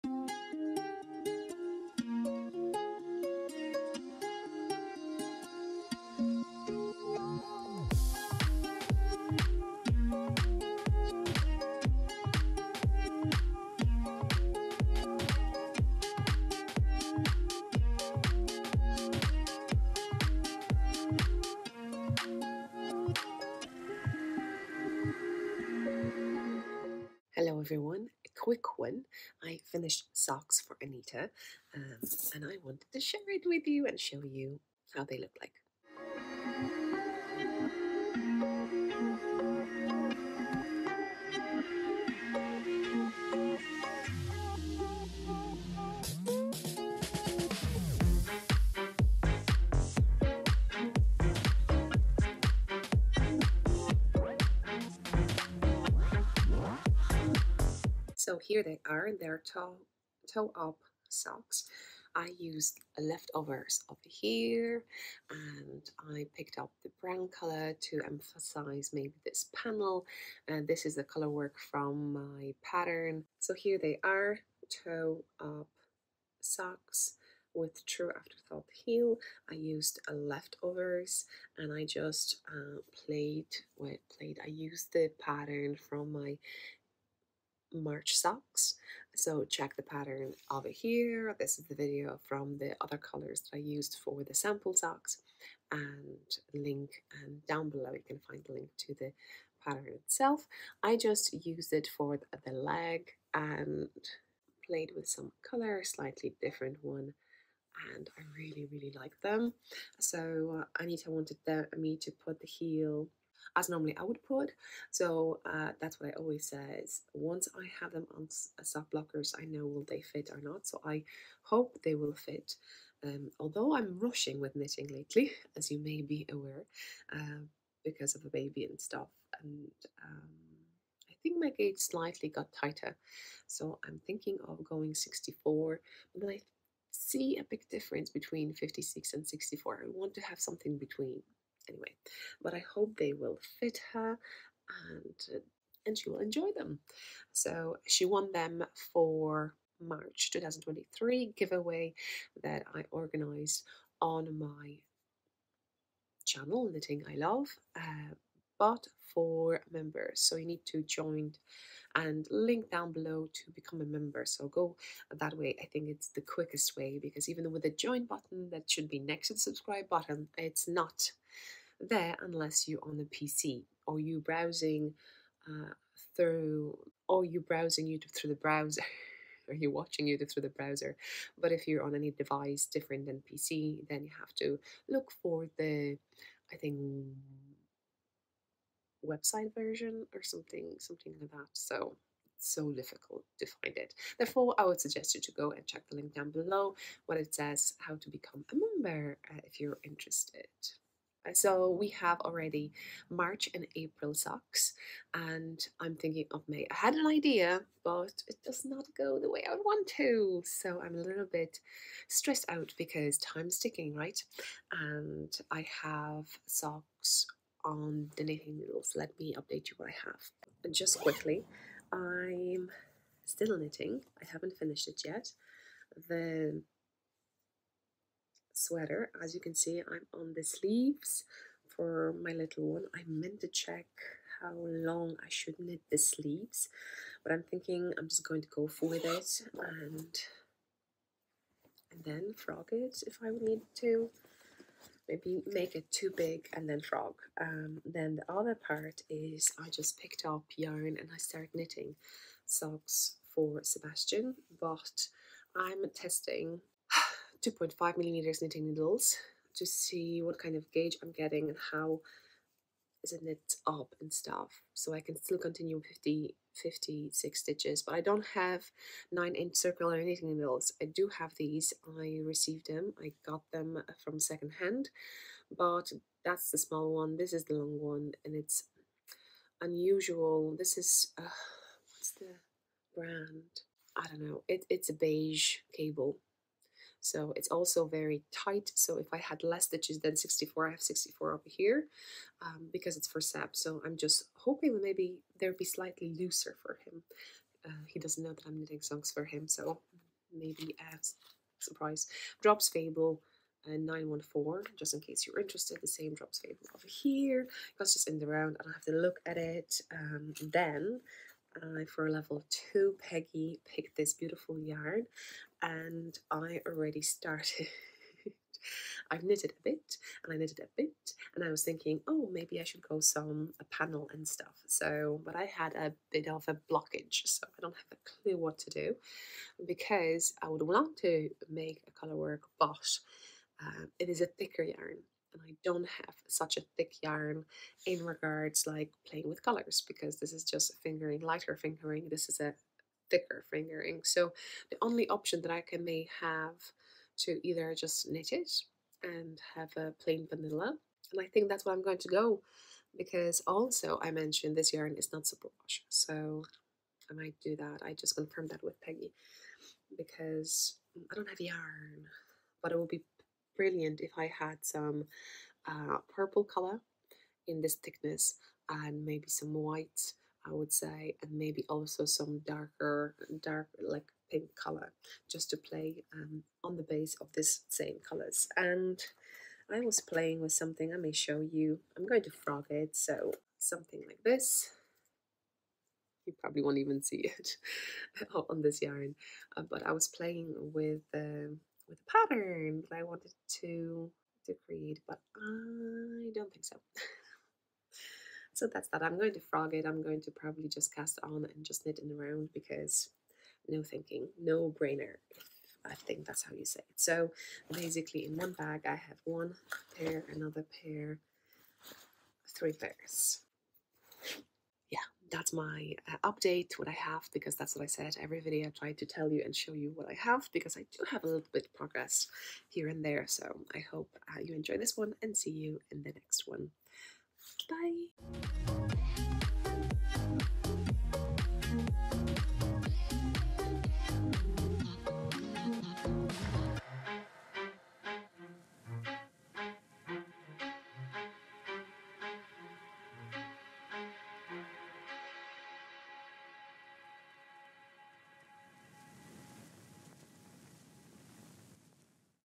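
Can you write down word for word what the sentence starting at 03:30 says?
So I'm a little bit stressed out because time's ticking, right?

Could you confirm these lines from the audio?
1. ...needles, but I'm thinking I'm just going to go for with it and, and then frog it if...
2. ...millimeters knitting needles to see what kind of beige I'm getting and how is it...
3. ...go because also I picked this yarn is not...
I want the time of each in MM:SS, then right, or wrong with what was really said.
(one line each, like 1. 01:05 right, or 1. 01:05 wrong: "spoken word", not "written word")
1. 03:55 wrong: "sleeves", not "needles"
2. 04:17 wrong: "gauge", not "beige"
3. 05:52 wrong: "mentioned", not "picked".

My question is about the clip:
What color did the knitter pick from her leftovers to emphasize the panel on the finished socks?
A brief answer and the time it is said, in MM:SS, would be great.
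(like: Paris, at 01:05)
Brown, at 01:07.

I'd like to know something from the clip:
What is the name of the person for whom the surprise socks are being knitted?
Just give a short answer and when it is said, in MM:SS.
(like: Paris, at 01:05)
Sebastian, at 04:13.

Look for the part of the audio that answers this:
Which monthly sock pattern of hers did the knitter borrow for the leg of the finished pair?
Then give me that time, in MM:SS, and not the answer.
01:27.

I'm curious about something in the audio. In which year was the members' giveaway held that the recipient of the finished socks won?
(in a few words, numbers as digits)
2023.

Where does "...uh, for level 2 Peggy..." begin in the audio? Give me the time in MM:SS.
05:11.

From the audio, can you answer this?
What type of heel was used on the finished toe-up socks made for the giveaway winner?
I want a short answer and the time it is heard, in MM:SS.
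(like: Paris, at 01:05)
True Afterthought Heel, at 01:17.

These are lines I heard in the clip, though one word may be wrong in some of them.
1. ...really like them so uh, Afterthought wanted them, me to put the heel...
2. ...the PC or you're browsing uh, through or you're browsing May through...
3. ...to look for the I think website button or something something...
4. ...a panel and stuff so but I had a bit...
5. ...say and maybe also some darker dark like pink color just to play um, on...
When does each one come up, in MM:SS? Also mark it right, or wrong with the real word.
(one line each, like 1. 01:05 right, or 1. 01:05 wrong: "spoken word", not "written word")
1. 01:48 wrong: "Anita", not "Afterthought"
2. 02:52 wrong: "YouTube", not "May"
3. 03:04 wrong: "version", not "button"
4. 05:23 right
5. 06:10 right.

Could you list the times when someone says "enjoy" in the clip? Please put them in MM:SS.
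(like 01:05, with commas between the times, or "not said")
02:26, 07:04.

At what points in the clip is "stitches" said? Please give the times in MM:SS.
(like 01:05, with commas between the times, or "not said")
04:27, 04:49.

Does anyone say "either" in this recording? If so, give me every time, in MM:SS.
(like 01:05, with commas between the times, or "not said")
05:47.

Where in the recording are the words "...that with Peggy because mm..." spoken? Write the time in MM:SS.
05:58.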